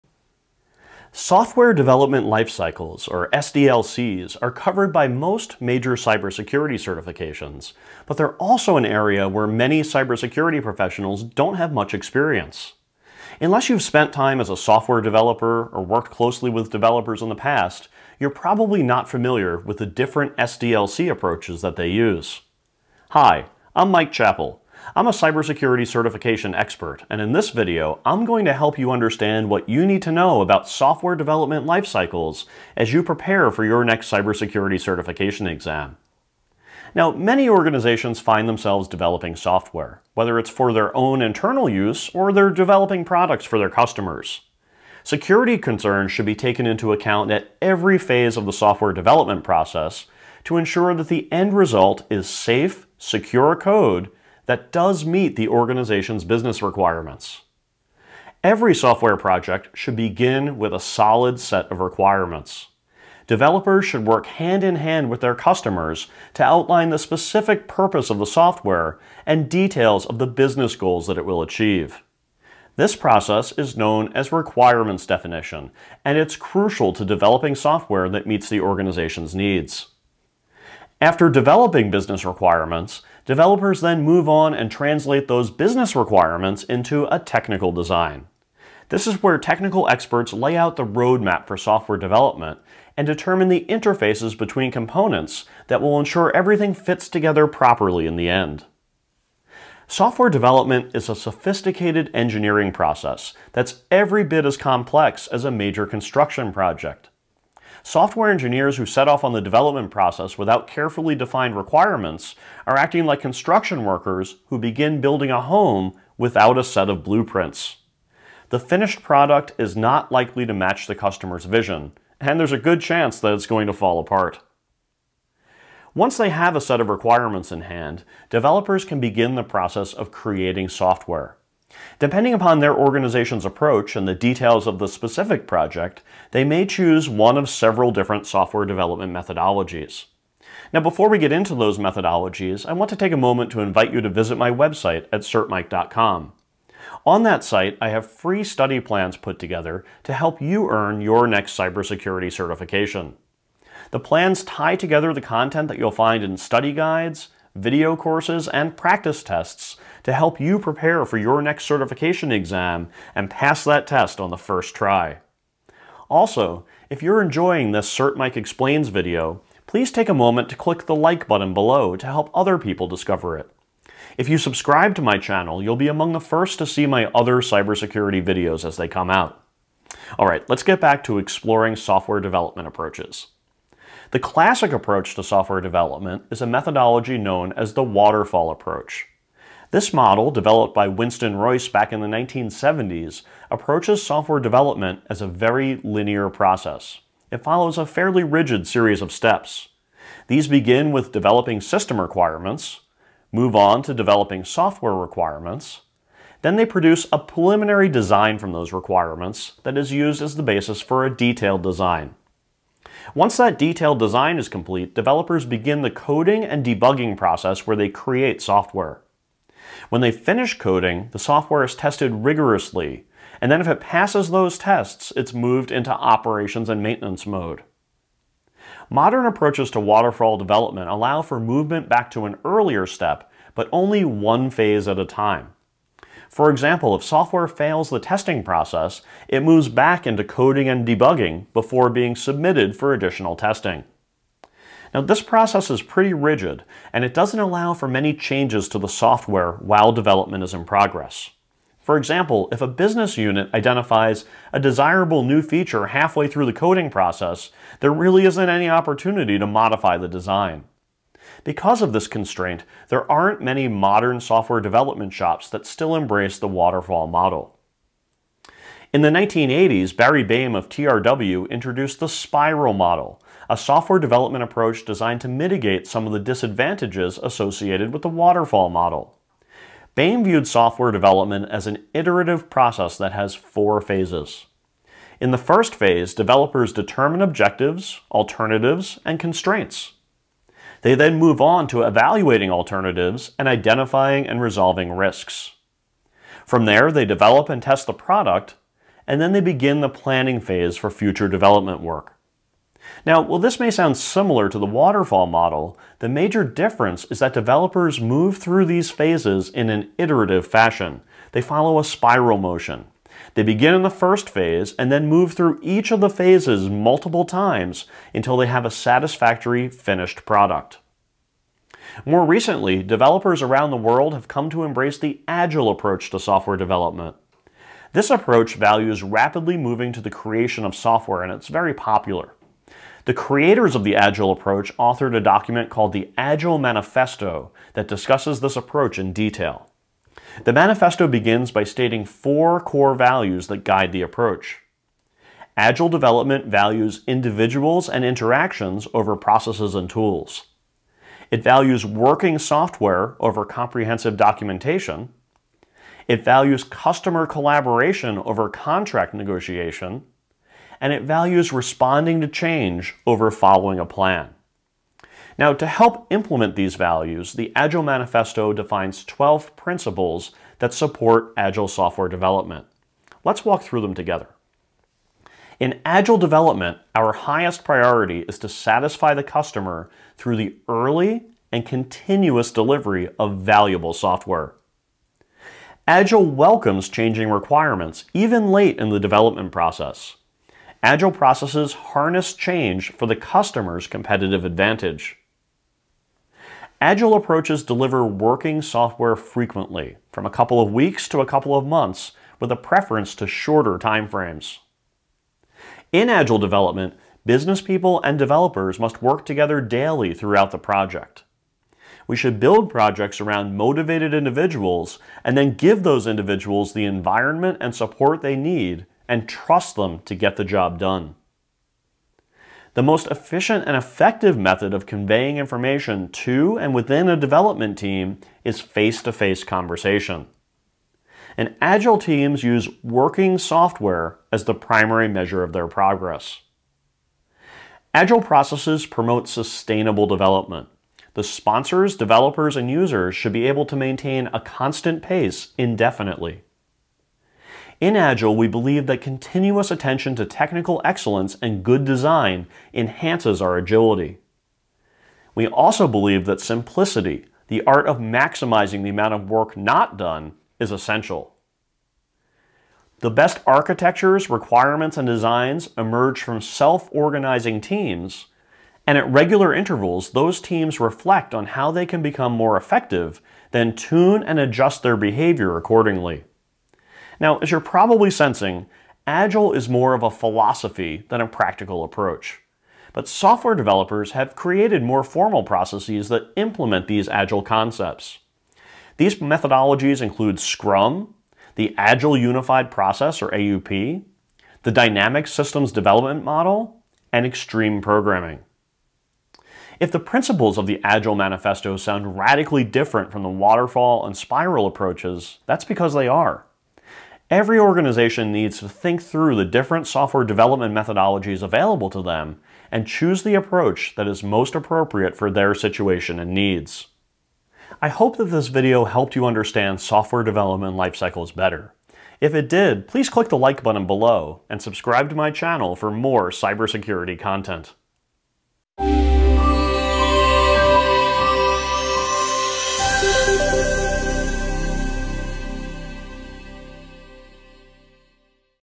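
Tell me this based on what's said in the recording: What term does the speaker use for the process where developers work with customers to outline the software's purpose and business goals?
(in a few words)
requirements definition.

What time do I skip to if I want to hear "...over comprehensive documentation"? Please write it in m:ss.
5:53.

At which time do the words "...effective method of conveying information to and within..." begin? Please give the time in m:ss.
7:03.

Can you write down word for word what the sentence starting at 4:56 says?
From there, they develop and test the product, and then they begin the planning phase for future development work.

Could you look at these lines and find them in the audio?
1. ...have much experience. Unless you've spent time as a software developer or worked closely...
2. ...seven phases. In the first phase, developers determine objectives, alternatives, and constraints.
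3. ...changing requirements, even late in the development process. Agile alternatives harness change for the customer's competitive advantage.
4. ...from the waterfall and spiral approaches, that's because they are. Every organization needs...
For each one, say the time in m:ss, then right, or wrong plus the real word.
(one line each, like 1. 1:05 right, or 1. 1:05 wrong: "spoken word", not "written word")
1. 0:11 right
2. 4:43 wrong: "four", not "seven"
3. 6:26 wrong: "processes", not "alternatives"
4. 8:23 right.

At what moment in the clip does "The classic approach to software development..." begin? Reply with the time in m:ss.
3:04.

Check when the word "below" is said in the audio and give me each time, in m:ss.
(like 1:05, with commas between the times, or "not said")
2:51, 8:43.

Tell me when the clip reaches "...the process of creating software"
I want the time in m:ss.
2:09.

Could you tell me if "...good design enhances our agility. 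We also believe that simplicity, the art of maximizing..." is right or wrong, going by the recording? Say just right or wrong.
right.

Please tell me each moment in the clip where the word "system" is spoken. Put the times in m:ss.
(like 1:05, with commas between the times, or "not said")
3:21, 8:15.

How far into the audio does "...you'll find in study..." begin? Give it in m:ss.
2:35.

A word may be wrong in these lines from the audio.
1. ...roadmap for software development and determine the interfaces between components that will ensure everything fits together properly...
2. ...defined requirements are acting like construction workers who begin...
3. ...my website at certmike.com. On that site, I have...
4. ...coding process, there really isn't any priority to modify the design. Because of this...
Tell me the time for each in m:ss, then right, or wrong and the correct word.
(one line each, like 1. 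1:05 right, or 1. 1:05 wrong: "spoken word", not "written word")
1. 1:30 right
2. 1:51 right
3. 2:24 right
4. 4:16 wrong: "opportunity", not "priority".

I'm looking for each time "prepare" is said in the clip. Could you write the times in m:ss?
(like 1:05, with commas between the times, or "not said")
0:33, 2:40.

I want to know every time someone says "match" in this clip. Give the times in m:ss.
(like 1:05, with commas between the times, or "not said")
2:00.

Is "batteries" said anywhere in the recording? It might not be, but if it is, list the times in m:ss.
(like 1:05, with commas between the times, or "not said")
not said.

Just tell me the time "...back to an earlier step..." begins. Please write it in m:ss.
3:51.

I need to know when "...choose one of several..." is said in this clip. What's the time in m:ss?
2:16.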